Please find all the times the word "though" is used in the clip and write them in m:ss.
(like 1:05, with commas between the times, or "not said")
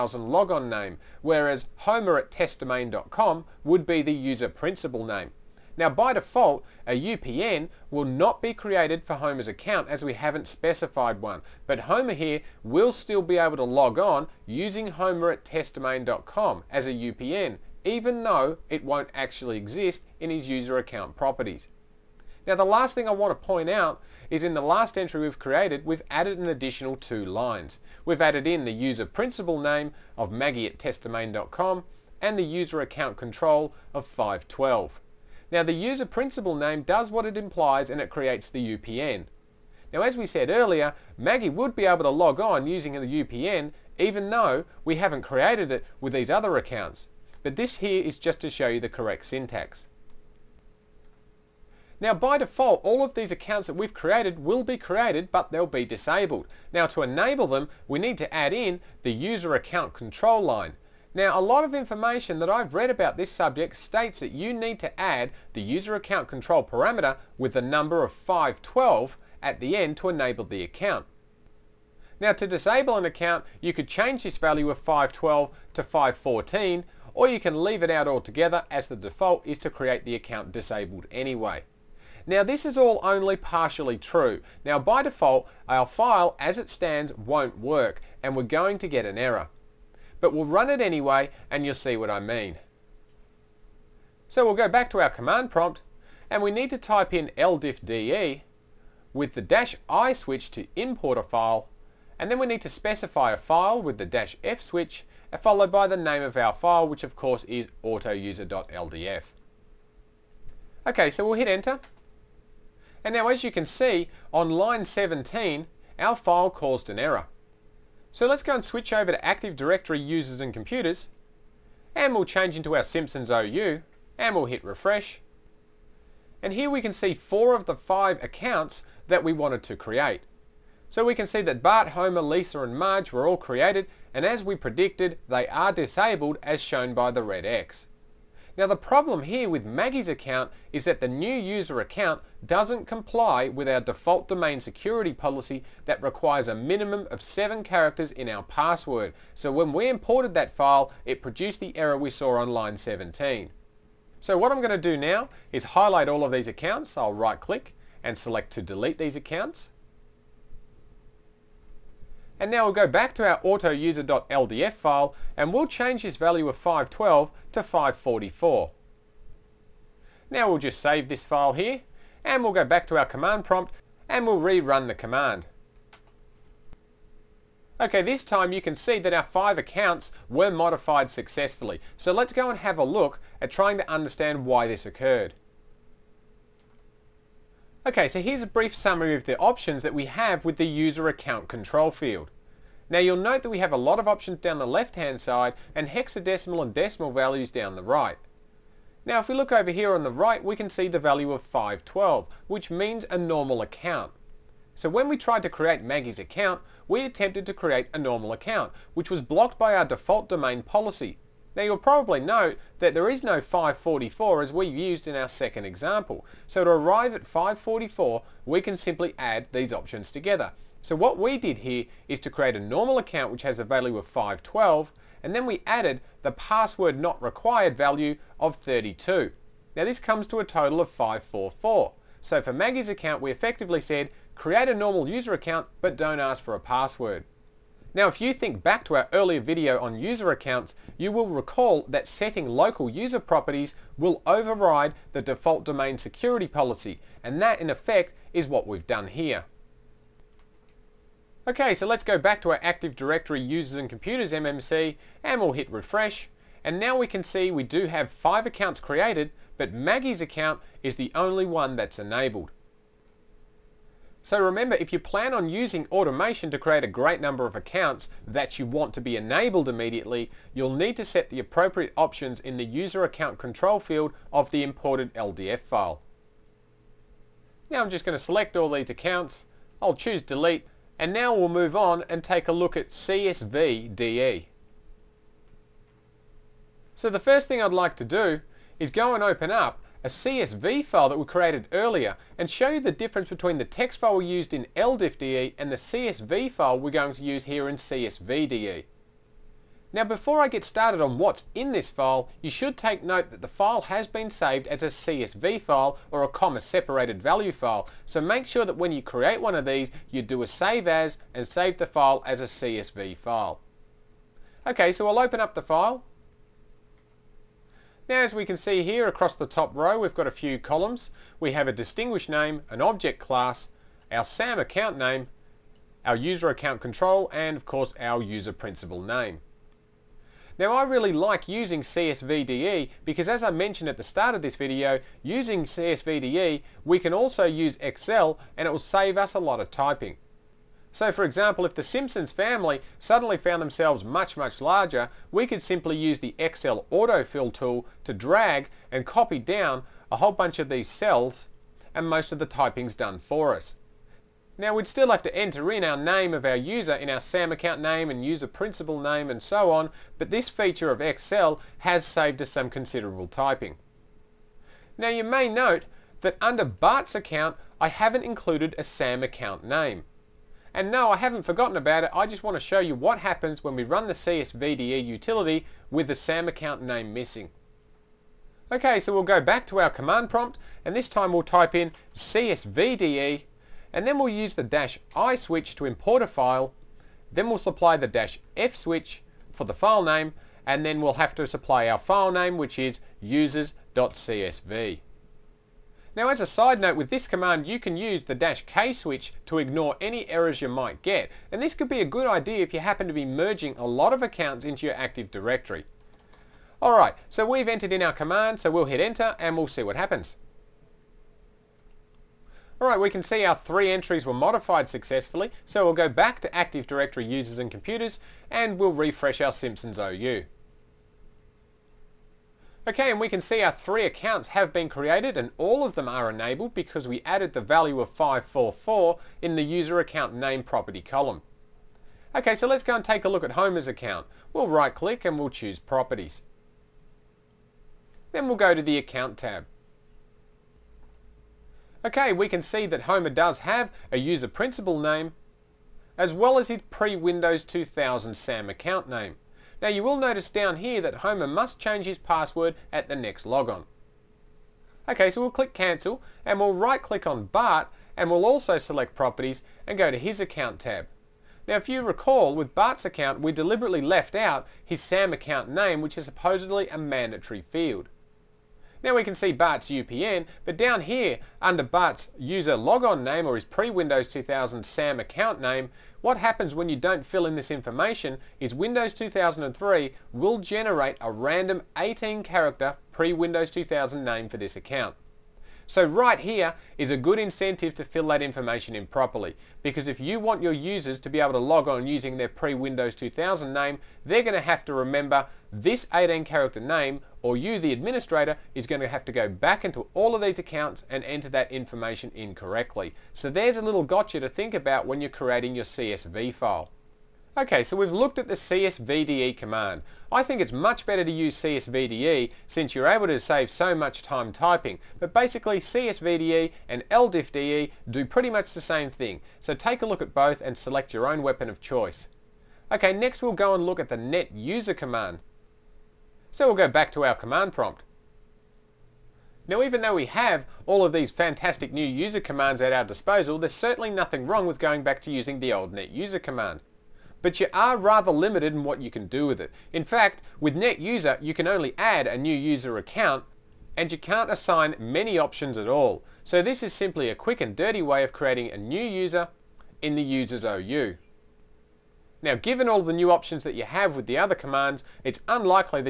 0:18, 0:44, 8:49.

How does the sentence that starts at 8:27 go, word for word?
Okay, so we've looked at the CSVDE command.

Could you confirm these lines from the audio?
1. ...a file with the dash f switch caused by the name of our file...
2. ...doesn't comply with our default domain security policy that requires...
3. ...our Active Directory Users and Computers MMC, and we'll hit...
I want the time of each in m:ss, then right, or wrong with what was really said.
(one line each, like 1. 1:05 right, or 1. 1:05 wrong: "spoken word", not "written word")
1. 1:43 wrong: "followed", not "caused"
2. 2:22 right
3. 4:12 right.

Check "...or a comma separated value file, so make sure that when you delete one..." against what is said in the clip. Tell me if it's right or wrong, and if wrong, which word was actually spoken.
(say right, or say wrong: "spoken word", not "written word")
wrong: "create", not "delete".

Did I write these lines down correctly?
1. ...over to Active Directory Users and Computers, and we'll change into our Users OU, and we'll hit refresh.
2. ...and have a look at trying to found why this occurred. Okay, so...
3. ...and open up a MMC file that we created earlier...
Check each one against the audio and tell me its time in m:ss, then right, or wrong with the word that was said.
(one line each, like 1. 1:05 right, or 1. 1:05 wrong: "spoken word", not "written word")
1. 1:58 wrong: "Simpsons", not "Users"
2. 3:02 wrong: "understand", not "found"
3. 4:49 wrong: "CSV", not "MMC".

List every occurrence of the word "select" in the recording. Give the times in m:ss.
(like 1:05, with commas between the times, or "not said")
2:38, 4:38, 7:38, 8:40.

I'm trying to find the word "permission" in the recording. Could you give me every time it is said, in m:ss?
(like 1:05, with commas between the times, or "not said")
not said.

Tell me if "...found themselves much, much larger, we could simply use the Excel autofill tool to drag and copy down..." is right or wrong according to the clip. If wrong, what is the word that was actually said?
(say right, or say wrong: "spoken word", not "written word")
right.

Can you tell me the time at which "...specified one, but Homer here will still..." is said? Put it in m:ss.
0:10.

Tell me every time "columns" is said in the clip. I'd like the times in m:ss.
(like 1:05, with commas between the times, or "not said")
5:20, 7:11.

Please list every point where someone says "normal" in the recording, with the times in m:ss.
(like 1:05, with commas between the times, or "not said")
3:23, 3:27, 3:42, 3:54.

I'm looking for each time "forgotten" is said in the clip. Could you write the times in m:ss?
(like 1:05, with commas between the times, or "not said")
6:11.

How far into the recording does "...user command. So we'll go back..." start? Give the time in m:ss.
8:44.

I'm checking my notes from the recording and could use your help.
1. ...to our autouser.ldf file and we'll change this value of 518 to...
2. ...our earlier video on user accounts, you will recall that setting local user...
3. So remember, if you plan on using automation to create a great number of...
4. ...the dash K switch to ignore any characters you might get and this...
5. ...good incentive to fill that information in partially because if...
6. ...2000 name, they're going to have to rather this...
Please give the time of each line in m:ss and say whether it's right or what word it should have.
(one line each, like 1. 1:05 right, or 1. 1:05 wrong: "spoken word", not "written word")
1. 2:43 wrong: "512", not "518"
2. 3:58 right
3. 4:24 right
4. 6:38 wrong: "errors", not "characters"
5. 8:07 wrong: "properly", not "partially"
6. 8:13 wrong: "remember", not "rather".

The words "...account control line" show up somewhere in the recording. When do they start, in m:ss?
0:59.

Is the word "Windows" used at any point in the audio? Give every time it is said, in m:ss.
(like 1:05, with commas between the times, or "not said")
7:26, 7:53, 7:58, 8:03, 8:12.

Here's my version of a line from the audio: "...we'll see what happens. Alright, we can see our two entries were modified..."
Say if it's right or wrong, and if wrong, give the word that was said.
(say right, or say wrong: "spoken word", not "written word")
wrong: "three", not "two".